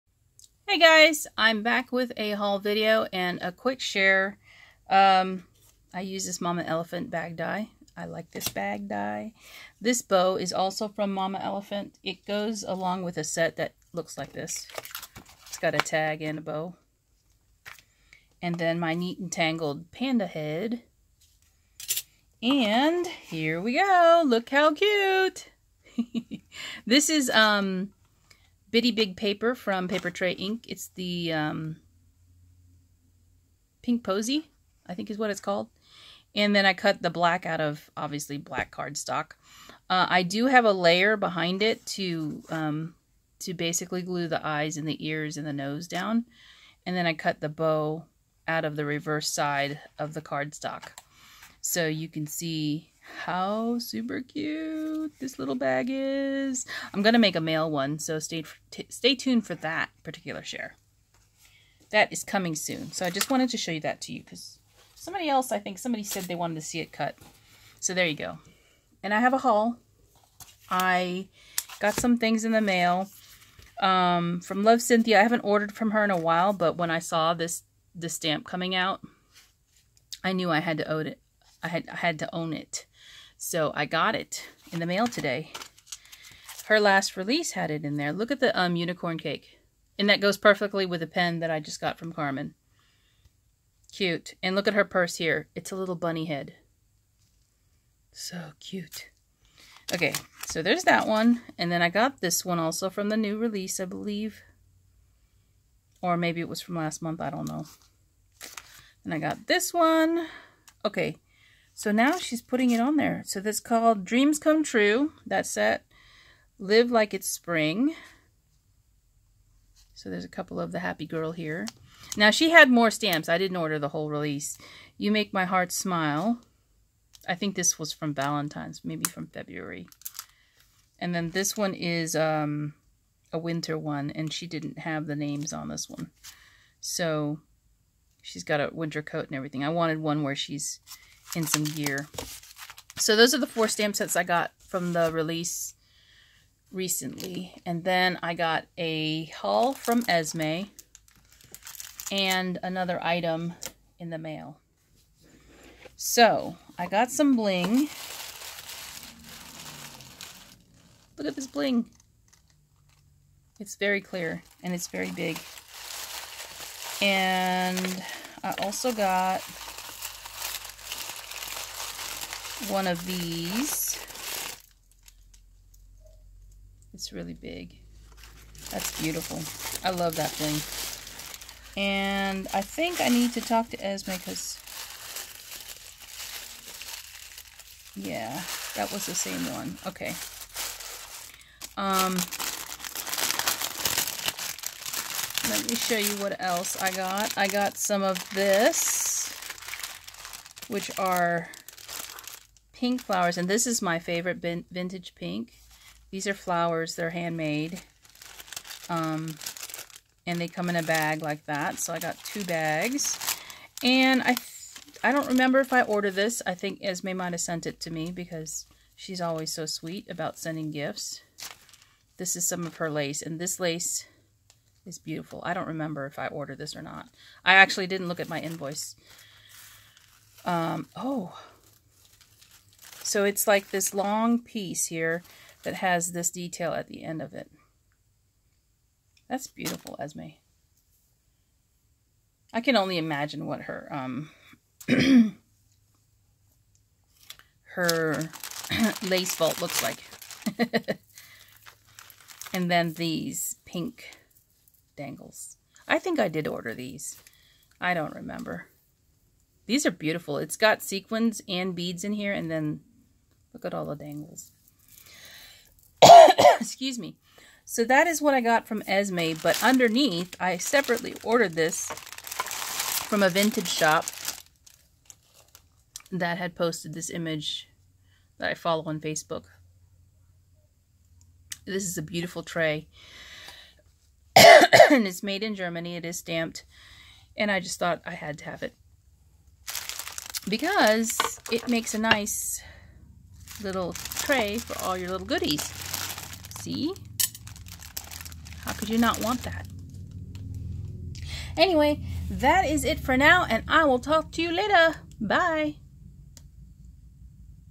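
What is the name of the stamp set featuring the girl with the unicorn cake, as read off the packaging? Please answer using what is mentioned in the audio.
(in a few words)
Dreams Come True.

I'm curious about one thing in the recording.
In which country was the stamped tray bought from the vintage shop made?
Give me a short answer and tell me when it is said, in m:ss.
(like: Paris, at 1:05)
Germany, at 4:45.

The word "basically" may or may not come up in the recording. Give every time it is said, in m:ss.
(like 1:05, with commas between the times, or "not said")
0:43.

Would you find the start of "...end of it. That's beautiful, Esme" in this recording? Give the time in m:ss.
3:57.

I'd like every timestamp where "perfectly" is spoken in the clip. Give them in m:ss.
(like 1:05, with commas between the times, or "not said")
1:30.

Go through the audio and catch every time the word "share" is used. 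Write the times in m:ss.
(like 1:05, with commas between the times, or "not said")
0:03, 1:00.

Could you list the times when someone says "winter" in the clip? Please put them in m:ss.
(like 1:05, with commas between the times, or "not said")
2:13, 2:18.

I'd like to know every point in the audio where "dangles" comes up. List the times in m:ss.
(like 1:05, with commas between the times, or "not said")
4:14, 4:23.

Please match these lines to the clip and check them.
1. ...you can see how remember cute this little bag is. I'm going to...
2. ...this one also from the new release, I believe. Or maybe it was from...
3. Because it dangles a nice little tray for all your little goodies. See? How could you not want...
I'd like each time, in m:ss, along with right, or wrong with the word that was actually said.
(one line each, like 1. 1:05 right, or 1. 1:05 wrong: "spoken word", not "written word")
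1. 0:51 wrong: "super", not "remember"
2. 1:42 right
3. 4:50 wrong: "makes", not "dangles".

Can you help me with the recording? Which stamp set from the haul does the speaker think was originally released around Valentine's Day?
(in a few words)
You Make My Heart Smile.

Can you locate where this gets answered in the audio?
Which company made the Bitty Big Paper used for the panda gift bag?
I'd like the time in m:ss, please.
0:29.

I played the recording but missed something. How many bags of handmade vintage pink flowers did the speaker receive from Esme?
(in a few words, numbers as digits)
2.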